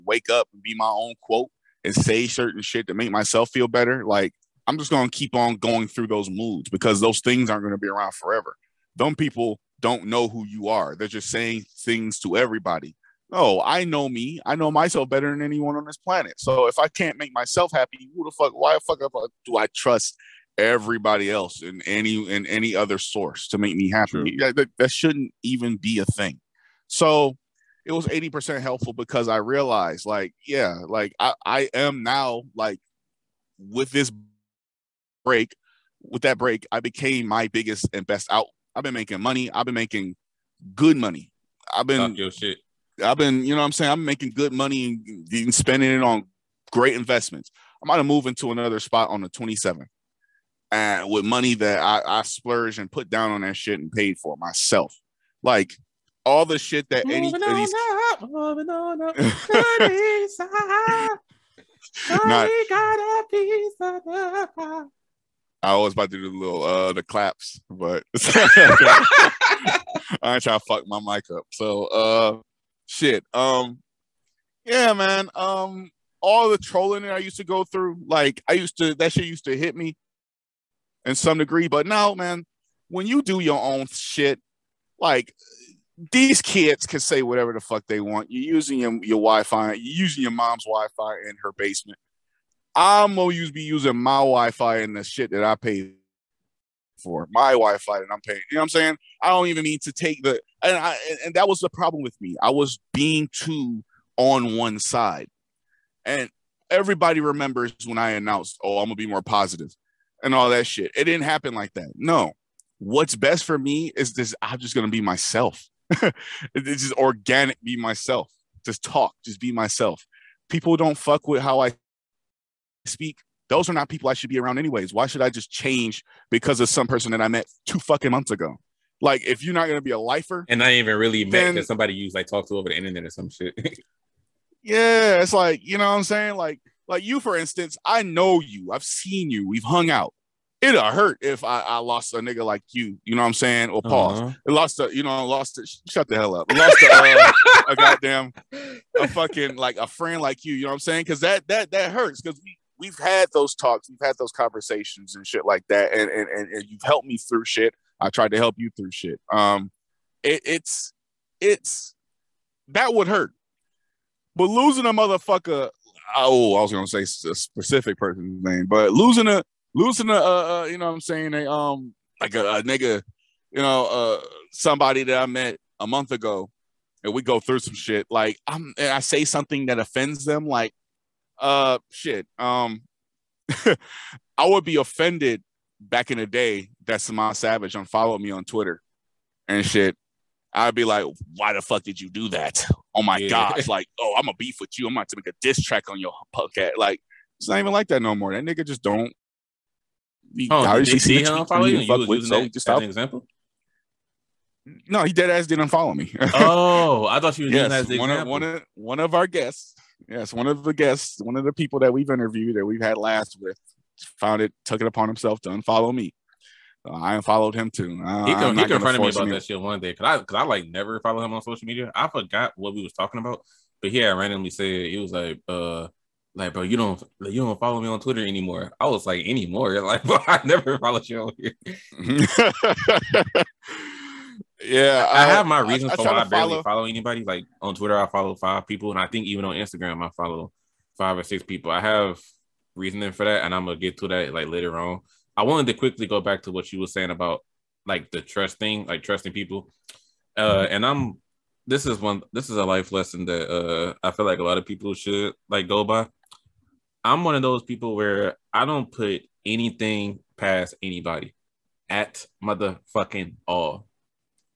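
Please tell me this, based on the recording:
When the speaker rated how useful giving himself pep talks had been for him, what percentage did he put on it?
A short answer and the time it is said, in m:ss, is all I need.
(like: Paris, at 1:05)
80%, at 0:28.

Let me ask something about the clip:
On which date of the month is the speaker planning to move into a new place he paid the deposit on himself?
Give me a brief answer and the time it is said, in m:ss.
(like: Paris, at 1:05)
27th, at 0:49.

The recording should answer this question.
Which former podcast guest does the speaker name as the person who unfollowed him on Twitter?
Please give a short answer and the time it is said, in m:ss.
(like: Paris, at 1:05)
Samad Savage, at 3:06.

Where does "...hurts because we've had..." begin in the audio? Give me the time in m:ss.
2:31.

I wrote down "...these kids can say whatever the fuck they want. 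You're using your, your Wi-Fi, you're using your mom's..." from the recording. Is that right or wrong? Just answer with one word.
right.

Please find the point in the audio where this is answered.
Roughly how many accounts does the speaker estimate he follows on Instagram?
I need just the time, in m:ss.
4:00.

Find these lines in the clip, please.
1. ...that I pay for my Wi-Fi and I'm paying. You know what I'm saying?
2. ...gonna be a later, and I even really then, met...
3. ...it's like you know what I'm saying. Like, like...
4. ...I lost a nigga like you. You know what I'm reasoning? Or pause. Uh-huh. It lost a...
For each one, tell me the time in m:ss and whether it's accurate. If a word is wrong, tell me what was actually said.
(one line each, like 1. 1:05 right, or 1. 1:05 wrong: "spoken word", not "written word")
1. 1:35 right
2. 2:09 wrong: "lifer", not "later"
3. 2:15 right
4. 2:21 wrong: "saying", not "reasoning".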